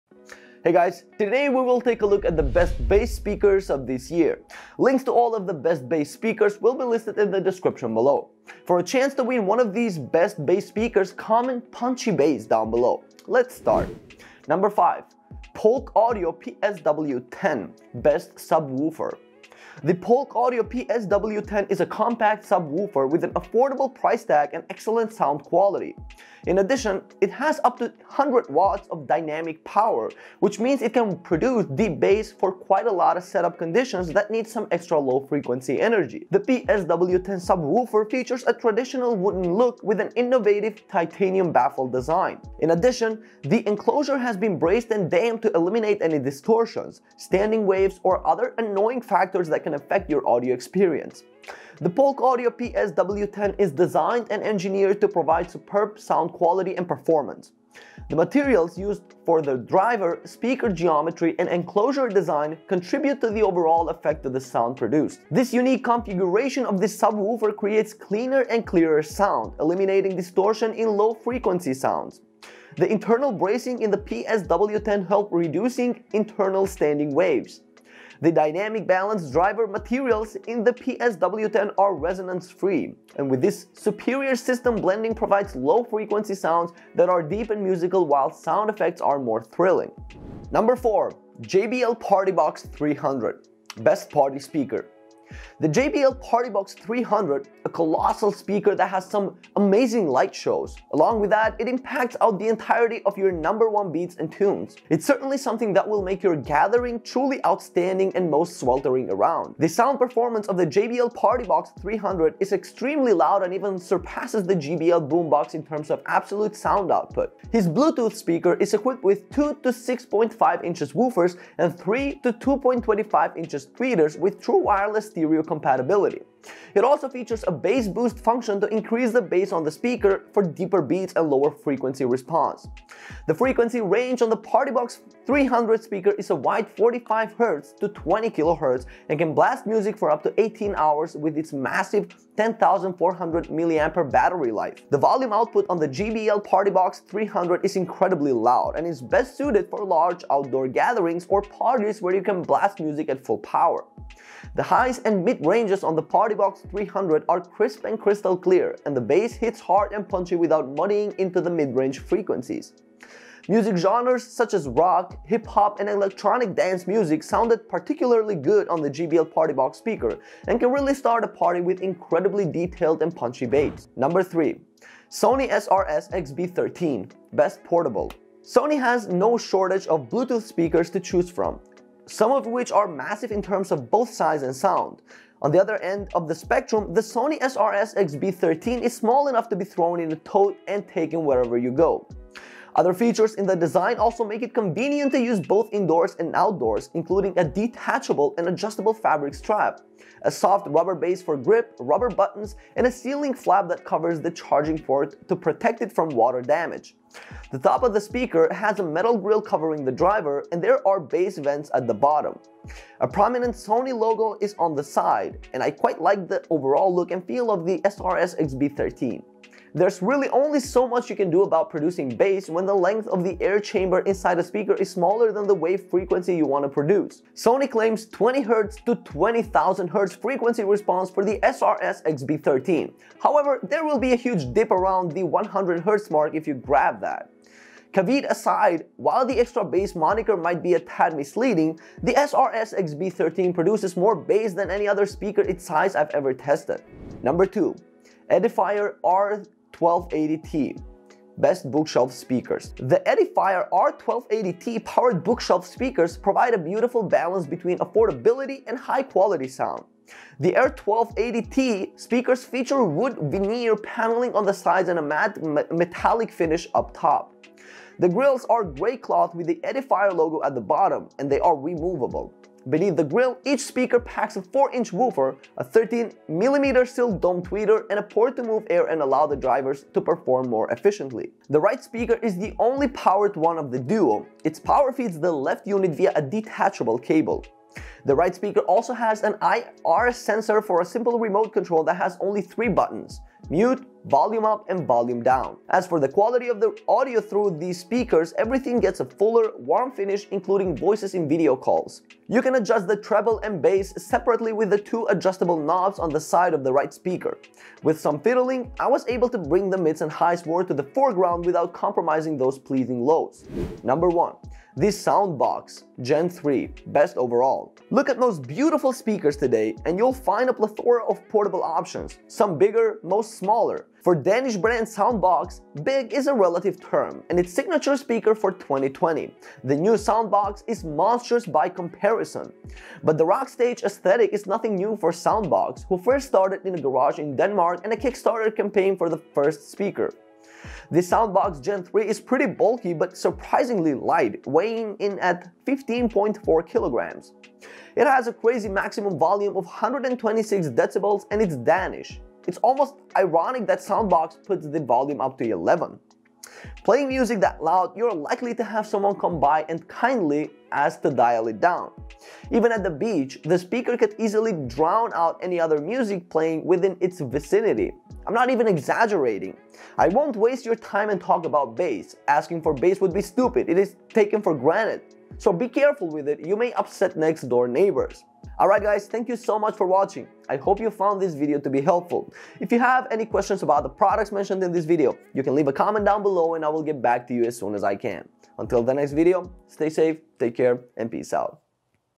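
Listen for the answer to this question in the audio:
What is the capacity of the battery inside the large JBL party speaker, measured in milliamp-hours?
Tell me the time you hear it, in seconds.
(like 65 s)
142 s.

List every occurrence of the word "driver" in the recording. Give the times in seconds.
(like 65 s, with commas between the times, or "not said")
59 s, 79 s, 209 s, 279 s.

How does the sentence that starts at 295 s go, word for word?
As for the quality of the audio through these speakers, everything gets a fuller, warm finish including voices in video calls.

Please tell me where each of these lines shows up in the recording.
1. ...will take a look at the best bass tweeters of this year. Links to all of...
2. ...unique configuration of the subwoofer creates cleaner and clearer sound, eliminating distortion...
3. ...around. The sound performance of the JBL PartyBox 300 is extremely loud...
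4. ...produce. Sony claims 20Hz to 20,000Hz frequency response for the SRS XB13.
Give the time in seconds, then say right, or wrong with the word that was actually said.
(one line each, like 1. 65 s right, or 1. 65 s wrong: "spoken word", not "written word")
1. 1 s wrong: "speakers", not "tweeters"
2. 65 s right
3. 109 s right
4. 226 s right.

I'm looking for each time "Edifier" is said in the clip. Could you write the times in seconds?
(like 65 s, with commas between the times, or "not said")
248 s, 253 s, 269 s.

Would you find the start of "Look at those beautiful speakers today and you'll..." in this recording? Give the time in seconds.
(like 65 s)
317 s.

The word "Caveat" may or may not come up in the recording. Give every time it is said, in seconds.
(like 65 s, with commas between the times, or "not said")
237 s.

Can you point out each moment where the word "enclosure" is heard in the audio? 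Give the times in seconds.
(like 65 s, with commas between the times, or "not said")
43 s, 61 s.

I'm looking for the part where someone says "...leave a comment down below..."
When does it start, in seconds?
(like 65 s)
385 s.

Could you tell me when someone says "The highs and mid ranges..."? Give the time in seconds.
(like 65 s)
154 s.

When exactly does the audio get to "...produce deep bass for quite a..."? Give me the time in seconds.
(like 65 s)
31 s.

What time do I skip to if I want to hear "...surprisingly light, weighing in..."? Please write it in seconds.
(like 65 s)
343 s.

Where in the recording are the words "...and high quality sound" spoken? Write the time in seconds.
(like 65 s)
258 s.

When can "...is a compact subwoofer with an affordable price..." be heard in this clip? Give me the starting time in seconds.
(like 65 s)
21 s.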